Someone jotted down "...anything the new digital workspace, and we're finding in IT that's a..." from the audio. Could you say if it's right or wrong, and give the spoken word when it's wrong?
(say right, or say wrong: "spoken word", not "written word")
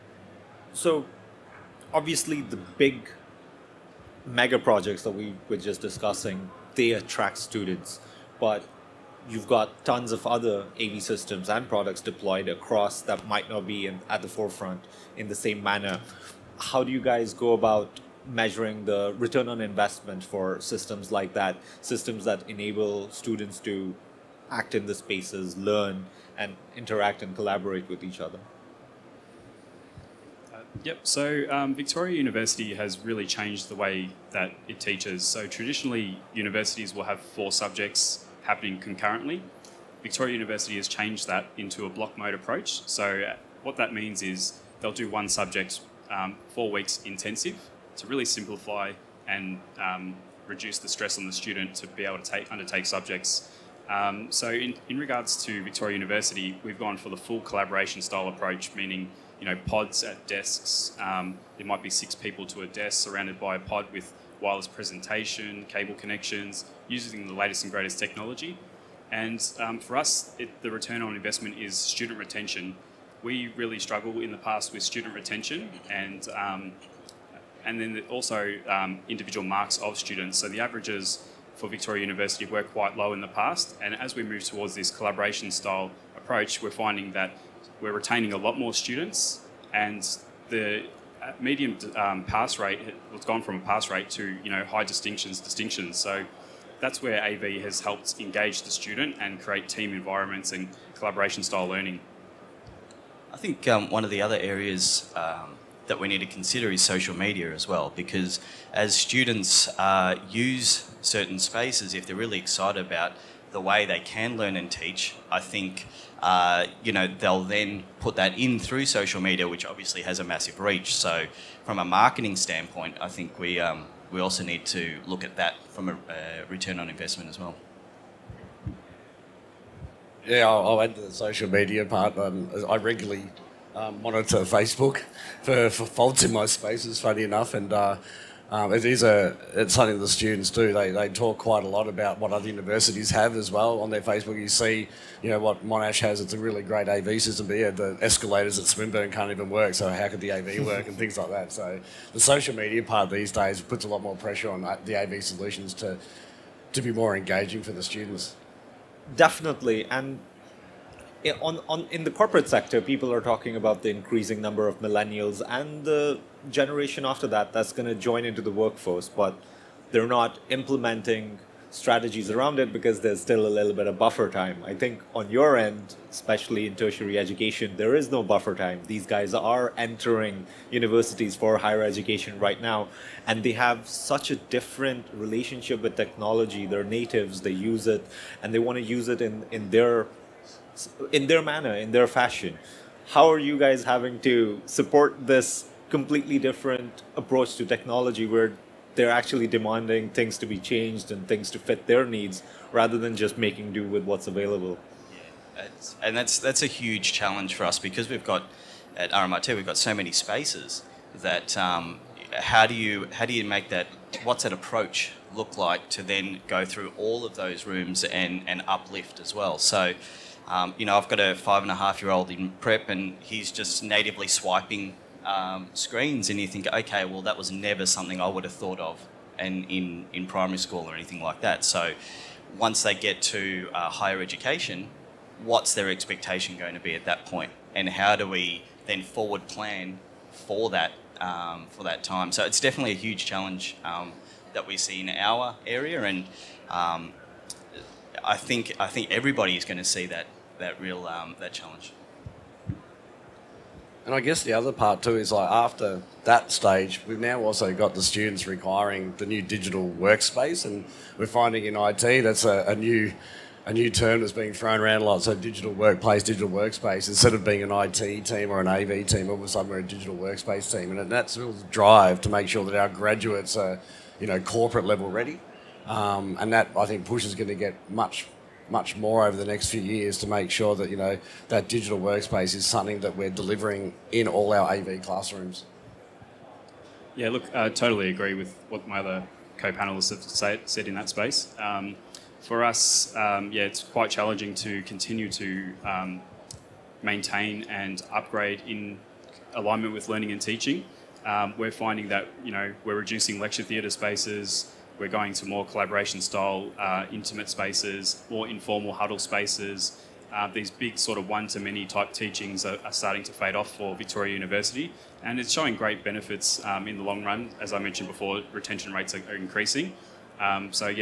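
wrong: "requiring", not "anything".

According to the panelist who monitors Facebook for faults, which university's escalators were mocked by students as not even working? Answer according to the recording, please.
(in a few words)
Swinburne.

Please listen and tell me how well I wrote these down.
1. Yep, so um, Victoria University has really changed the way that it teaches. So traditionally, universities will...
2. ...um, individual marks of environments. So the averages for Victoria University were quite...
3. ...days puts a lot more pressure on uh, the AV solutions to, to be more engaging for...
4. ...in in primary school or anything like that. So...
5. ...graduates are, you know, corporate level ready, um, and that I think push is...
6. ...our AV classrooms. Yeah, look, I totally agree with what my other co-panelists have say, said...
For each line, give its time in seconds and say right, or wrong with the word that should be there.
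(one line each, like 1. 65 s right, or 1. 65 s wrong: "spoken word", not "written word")
1. 30 s right
2. 78 s wrong: "students", not "environments"
3. 153 s right
4. 229 s right
5. 272 s right
6. 284 s right.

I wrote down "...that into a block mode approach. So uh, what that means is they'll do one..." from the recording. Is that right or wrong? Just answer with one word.
right.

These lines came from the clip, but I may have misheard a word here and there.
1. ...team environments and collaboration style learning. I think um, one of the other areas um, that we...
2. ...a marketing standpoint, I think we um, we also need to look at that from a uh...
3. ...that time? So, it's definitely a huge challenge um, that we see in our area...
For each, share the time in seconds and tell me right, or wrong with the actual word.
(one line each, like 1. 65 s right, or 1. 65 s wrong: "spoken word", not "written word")
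1. 99 s right
2. 121 s right
3. 241 s right.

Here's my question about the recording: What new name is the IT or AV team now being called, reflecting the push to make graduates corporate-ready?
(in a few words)
digital workspace team.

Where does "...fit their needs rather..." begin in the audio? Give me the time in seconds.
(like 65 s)
201 s.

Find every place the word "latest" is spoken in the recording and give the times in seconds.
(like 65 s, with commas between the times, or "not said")
67 s.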